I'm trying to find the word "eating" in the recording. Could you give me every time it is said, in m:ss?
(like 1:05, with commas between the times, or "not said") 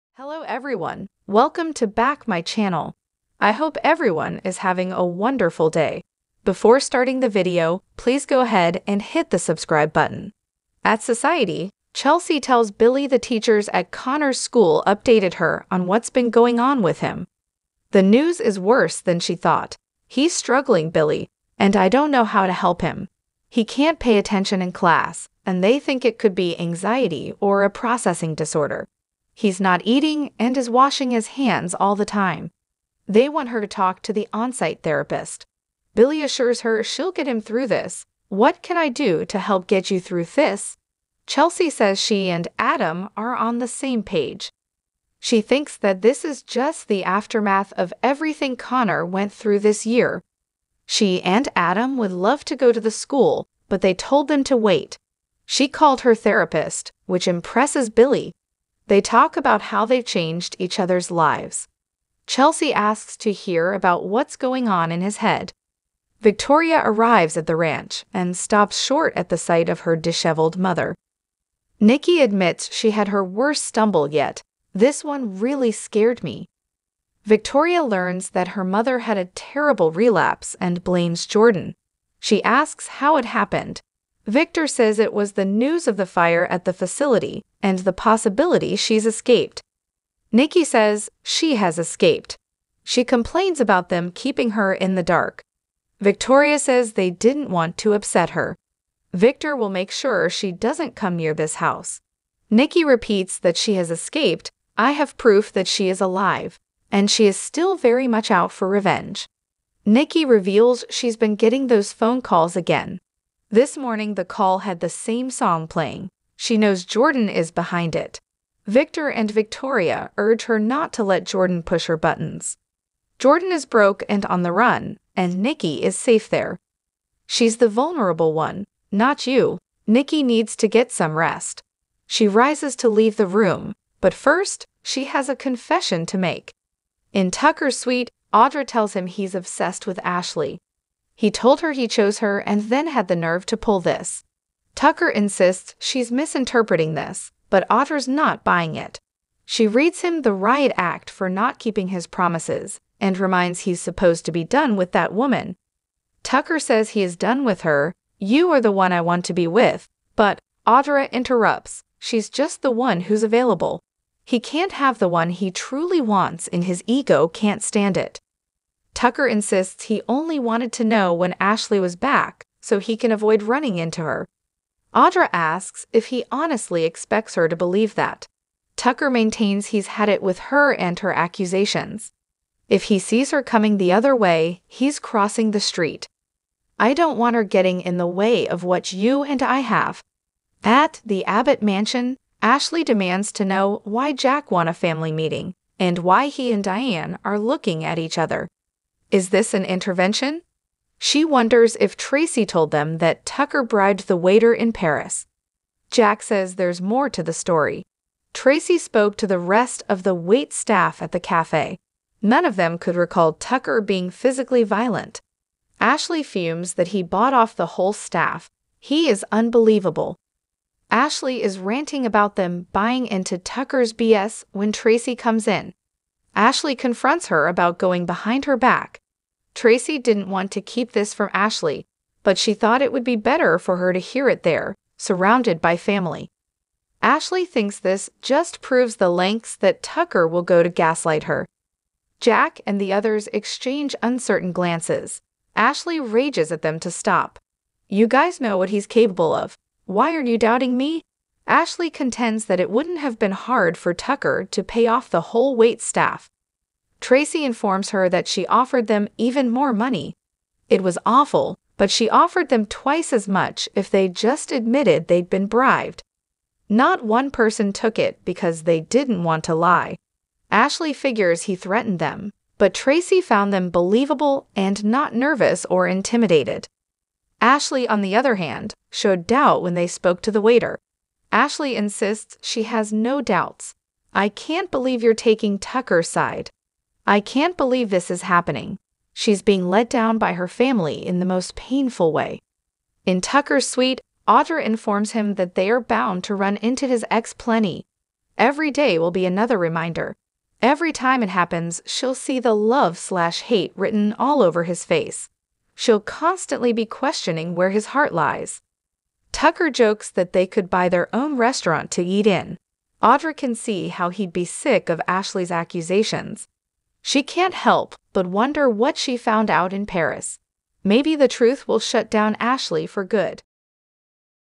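0:29.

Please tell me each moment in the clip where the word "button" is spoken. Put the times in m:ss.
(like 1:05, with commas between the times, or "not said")
0:09, 2:01.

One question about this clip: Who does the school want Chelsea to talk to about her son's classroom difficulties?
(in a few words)
on site therapist.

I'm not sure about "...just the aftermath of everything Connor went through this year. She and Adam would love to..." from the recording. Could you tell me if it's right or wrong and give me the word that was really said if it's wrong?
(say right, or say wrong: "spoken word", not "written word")
right.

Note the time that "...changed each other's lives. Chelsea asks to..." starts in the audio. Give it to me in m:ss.
1:00.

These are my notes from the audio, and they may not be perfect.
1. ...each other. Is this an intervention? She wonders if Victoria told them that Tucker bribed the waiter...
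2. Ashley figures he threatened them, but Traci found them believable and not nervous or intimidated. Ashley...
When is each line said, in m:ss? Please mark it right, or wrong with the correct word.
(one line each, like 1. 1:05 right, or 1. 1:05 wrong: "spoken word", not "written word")
1. 3:17 wrong: "Traci", not "Victoria"
2. 4:30 right.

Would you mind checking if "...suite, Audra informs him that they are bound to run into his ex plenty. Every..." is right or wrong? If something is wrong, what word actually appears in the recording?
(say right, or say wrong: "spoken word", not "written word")
right.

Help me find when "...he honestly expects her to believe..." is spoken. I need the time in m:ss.
2:56.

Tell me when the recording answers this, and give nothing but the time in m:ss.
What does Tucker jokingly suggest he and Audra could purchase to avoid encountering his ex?
5:10.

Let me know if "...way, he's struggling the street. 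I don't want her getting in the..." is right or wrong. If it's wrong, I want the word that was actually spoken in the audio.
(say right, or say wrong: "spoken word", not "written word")
wrong: "crossing", not "struggling".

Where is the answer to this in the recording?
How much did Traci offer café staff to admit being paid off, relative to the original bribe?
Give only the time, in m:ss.
4:22.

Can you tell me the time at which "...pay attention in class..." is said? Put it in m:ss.
0:23.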